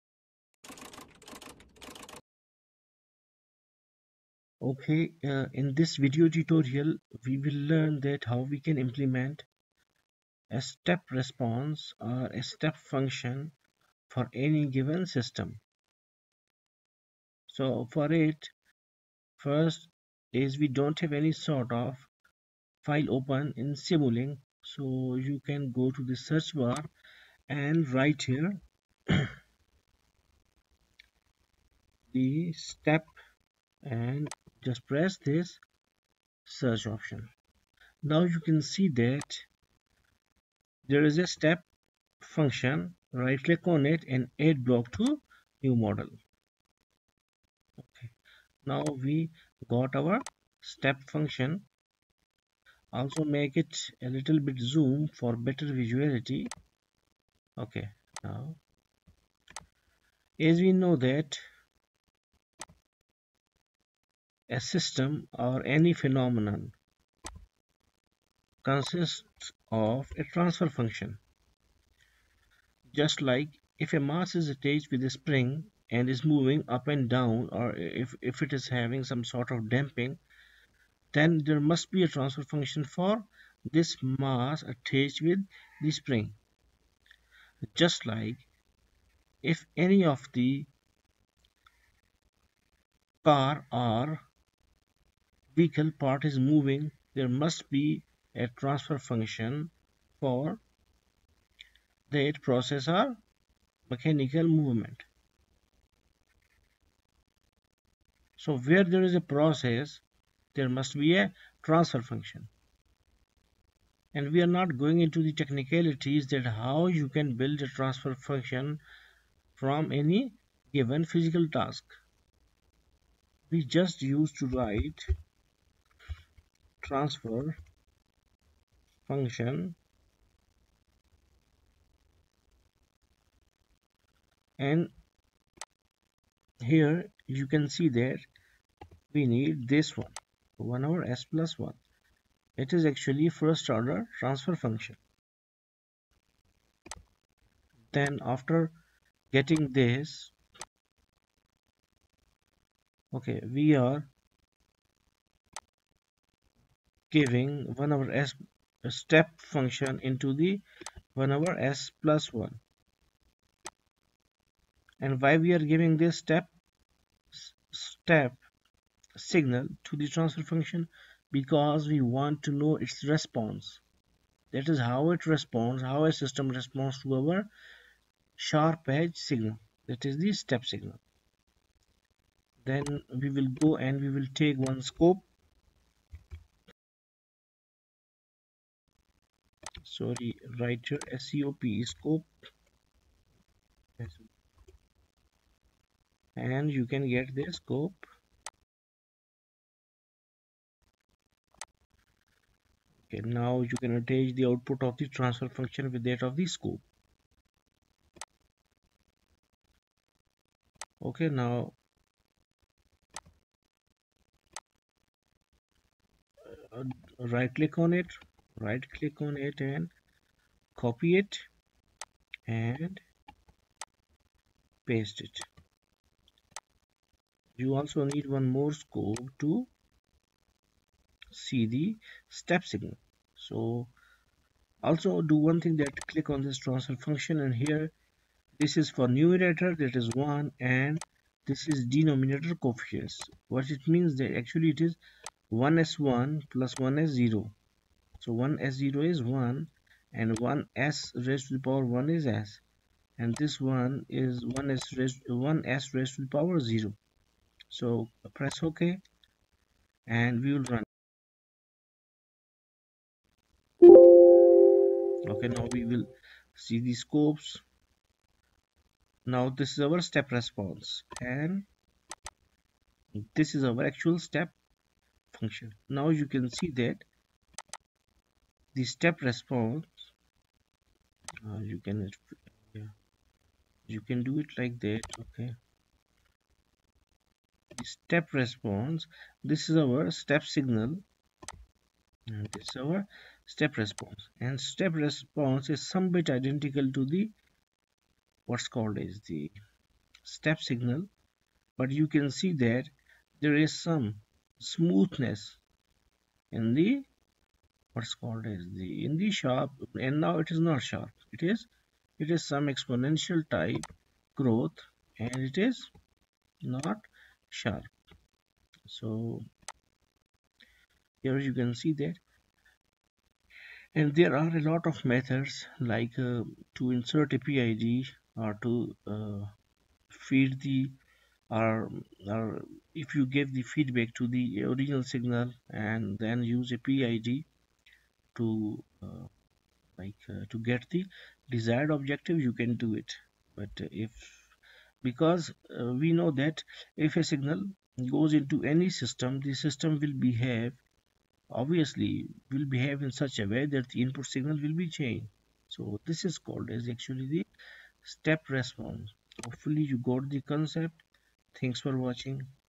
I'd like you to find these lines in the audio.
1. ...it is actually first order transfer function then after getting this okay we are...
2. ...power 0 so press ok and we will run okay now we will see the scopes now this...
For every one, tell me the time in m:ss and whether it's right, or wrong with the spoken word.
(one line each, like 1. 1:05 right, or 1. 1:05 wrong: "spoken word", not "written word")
1. 2:22 right
2. 4:16 right.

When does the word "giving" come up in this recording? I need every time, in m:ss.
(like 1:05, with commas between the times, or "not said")
2:37, 2:45.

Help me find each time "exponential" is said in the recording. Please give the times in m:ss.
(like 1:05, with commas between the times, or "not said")
5:12.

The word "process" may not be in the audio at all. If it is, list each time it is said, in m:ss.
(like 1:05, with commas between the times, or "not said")
1:42, 1:49.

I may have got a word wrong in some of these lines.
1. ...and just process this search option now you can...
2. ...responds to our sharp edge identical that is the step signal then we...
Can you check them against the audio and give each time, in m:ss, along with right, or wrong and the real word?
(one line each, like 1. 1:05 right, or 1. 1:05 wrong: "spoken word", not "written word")
1. 0:33 wrong: "press", not "process"
2. 2:56 wrong: "signal", not "identical".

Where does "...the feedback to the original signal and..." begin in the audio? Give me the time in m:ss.
5:33.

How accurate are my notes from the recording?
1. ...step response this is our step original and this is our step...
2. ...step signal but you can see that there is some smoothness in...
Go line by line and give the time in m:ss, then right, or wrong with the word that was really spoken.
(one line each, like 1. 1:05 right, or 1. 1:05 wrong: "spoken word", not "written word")
1. 4:47 wrong: "signal", not "original"
2. 5:00 right.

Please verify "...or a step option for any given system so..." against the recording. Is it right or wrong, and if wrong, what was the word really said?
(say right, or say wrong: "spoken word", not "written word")
wrong: "function", not "option".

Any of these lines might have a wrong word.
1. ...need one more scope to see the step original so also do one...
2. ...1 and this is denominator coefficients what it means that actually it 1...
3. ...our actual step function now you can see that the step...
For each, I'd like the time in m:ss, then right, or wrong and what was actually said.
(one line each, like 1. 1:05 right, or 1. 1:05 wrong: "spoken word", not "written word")
1. 3:48 wrong: "signal", not "original"
2. 4:00 right
3. 4:33 right.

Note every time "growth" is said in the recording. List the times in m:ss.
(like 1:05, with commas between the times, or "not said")
5:14.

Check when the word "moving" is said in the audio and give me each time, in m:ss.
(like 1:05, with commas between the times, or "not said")
1:16, 1:36.